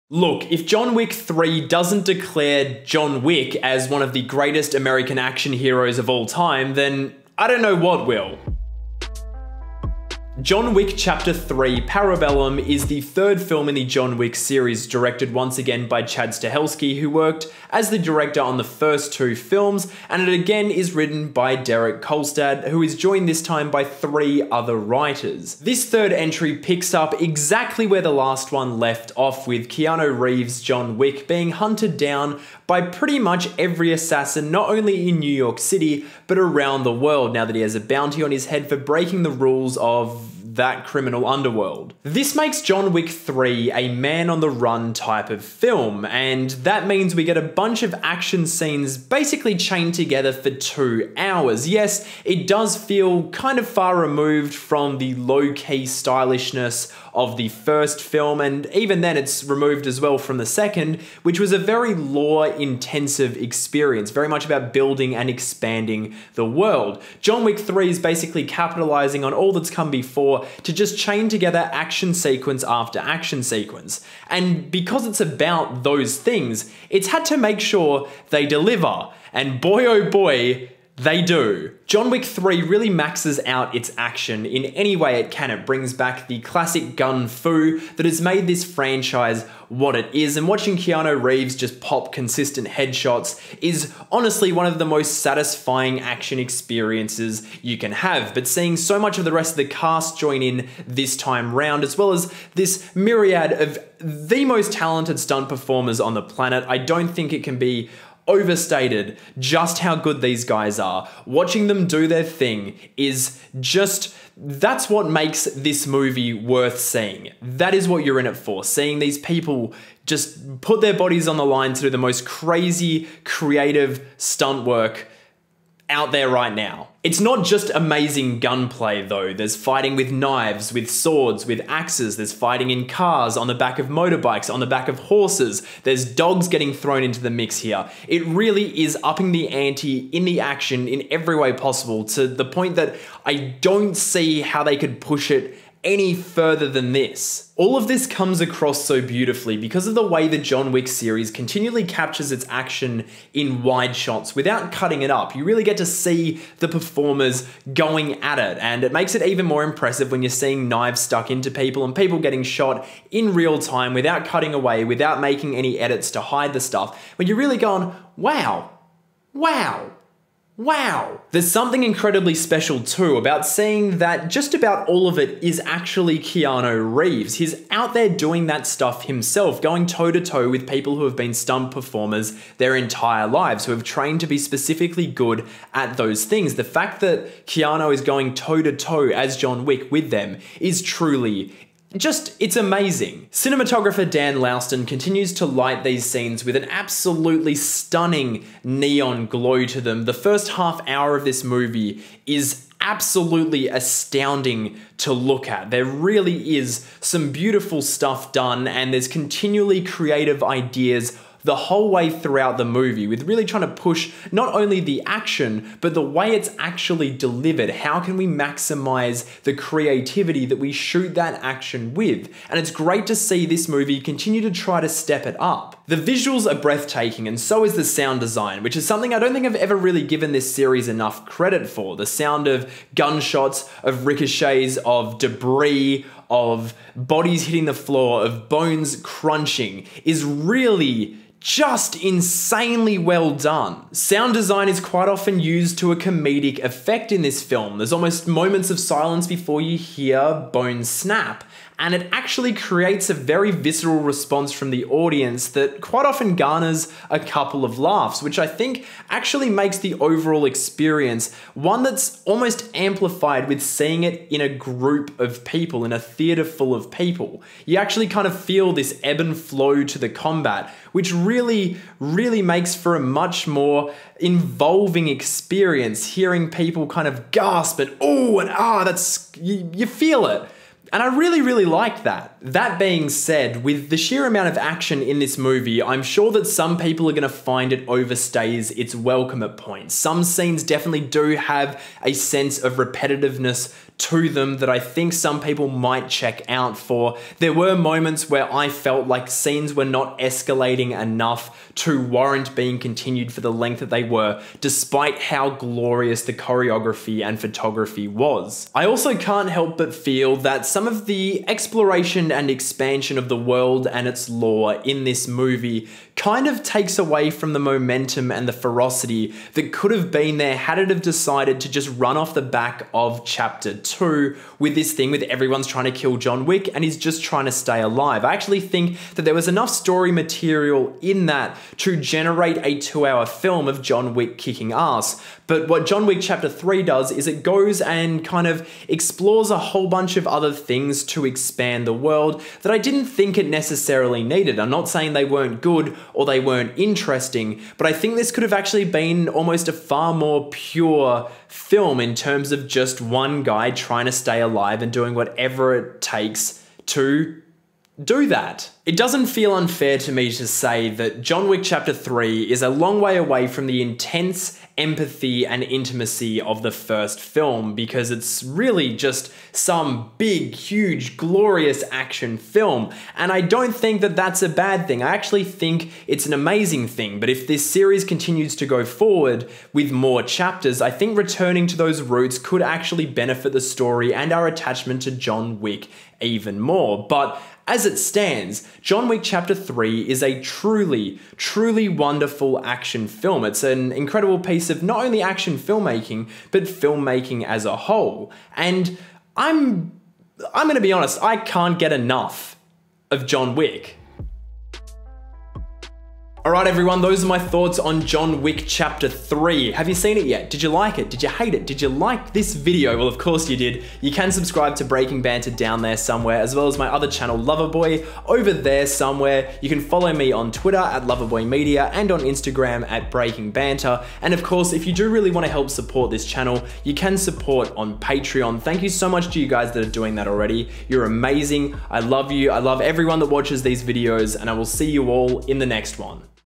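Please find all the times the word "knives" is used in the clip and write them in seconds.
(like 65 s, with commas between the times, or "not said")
130 s, 160 s.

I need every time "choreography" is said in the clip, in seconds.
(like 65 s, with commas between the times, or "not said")
306 s.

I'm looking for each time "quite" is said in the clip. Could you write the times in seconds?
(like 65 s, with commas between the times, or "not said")
244 s, 255 s.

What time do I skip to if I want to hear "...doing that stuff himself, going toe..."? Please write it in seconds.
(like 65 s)
178 s.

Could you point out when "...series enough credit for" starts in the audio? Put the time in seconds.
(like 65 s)
230 s.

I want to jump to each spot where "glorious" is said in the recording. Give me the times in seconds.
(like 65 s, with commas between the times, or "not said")
305 s, 371 s.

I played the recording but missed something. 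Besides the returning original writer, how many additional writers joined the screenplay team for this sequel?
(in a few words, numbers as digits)
3.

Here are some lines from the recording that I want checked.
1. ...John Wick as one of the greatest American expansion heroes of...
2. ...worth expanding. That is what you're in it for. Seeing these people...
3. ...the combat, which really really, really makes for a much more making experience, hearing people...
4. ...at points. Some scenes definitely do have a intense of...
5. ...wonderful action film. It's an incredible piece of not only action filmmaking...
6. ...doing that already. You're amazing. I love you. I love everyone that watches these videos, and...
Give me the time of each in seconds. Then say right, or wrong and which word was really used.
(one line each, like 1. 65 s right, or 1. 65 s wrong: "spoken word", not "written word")
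1. 2 s wrong: "action", not "expansion"
2. 116 s wrong: "seeing", not "expanding"
3. 269 s wrong: "involving", not "making"
4. 289 s wrong: "sense", not "intense"
5. 391 s right
6. 429 s right.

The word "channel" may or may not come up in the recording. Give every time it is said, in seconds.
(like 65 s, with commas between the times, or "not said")
417 s, 426 s.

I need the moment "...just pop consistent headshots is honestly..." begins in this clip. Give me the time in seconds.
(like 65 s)
91 s.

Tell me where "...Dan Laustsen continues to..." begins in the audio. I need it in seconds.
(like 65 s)
194 s.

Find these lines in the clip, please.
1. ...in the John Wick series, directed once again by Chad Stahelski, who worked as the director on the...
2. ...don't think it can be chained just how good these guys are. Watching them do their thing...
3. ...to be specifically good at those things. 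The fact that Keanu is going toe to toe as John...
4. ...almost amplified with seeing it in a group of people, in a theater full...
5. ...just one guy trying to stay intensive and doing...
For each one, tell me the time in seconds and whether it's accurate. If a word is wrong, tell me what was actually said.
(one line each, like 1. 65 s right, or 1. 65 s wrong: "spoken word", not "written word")
1. 13 s right
2. 106 s wrong: "overstated", not "chained"
3. 184 s right
4. 262 s right
5. 352 s wrong: "alive", not "intensive".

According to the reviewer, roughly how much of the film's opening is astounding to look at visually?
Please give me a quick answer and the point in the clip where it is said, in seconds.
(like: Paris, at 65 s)
The first half hour, at 200 s.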